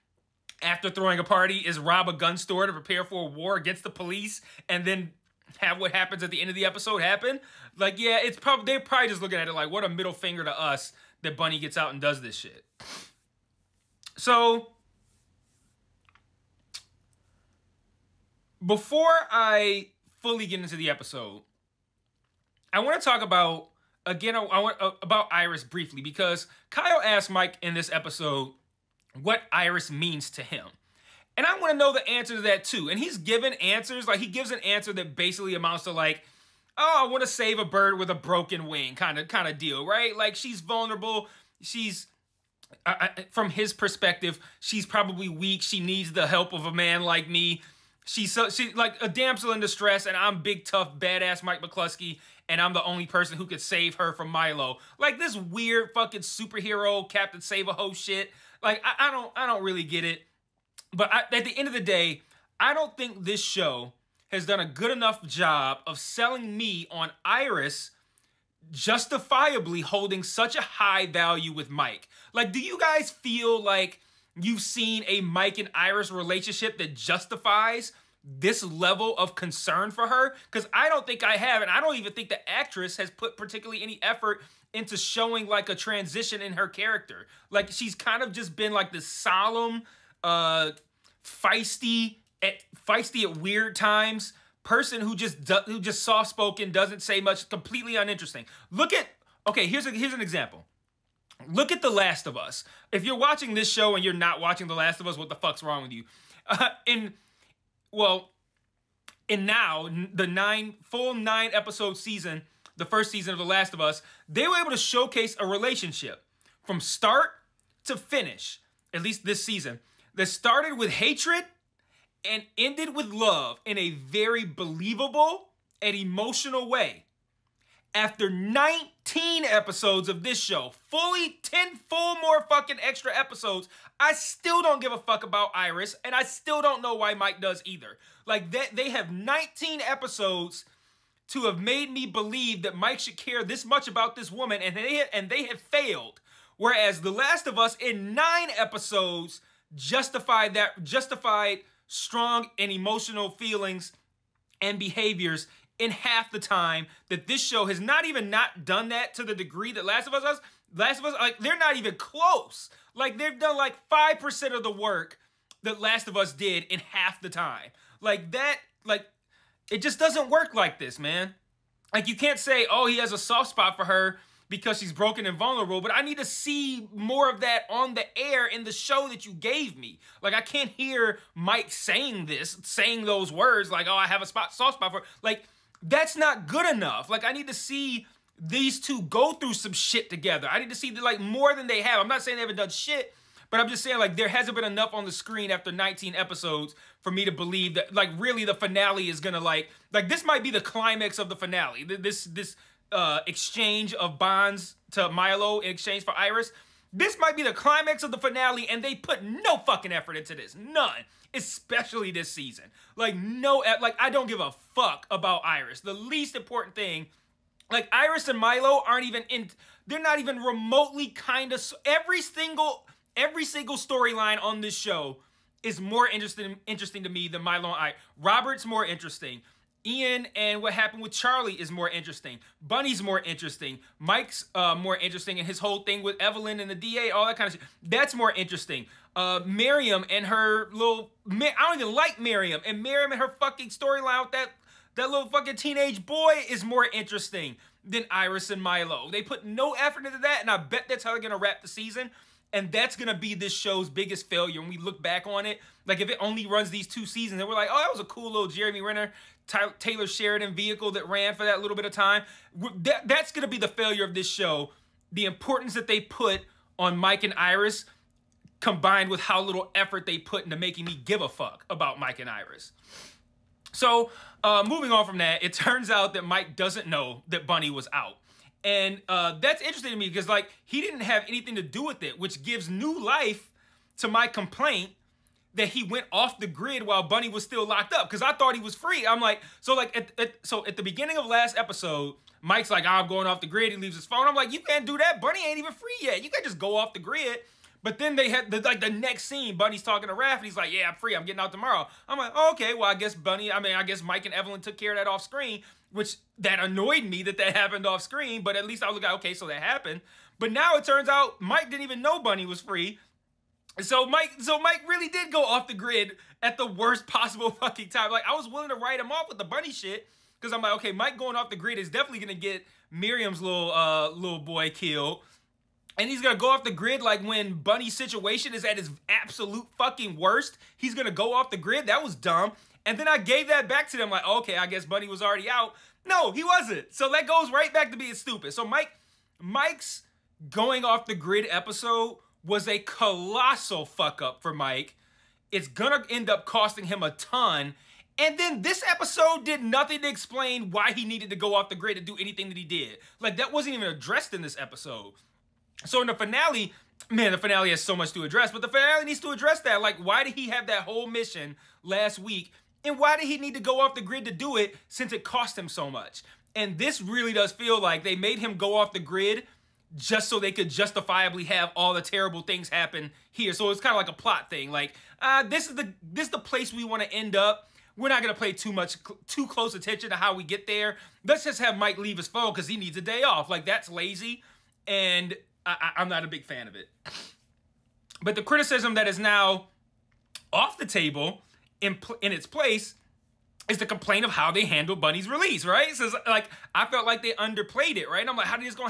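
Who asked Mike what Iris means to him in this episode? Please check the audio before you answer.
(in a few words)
Kyle.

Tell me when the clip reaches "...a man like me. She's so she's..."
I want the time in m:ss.
0:46.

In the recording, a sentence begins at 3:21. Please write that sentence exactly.
This, this, uh, exchange of bonds to Milo in exchange for Iris.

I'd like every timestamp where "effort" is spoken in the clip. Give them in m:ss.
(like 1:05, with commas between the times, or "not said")
1:24, 3:29, 4:09, 4:29.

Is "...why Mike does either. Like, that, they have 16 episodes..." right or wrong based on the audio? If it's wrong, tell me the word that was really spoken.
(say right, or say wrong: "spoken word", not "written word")
wrong: "19", not "16".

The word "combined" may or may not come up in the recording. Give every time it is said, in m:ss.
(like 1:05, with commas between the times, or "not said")
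4:28.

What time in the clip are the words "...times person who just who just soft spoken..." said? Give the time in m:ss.
1:33.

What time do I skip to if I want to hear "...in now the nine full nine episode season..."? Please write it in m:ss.
1:49.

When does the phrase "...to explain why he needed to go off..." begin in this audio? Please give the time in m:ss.
5:50.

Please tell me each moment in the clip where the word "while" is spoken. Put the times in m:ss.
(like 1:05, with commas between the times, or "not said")
4:46.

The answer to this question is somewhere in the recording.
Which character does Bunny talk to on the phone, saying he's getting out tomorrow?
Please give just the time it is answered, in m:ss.
5:00.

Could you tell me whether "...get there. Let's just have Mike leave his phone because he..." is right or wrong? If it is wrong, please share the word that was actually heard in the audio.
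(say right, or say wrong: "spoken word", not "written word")
right.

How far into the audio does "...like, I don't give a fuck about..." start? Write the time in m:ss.
3:33.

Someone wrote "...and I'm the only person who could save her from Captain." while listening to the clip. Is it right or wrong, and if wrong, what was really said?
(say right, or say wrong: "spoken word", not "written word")
wrong: "Milo", not "Captain".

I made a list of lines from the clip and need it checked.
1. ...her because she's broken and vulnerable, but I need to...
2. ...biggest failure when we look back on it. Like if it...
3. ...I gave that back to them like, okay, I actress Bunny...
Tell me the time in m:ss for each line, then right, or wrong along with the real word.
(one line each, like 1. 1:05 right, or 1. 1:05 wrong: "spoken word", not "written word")
1. 2:53 right
2. 4:13 right
3. 5:33 wrong: "guess", not "actress".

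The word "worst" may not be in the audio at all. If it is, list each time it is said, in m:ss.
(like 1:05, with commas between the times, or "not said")
5:16, 5:30.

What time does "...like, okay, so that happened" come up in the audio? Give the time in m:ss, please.
5:09.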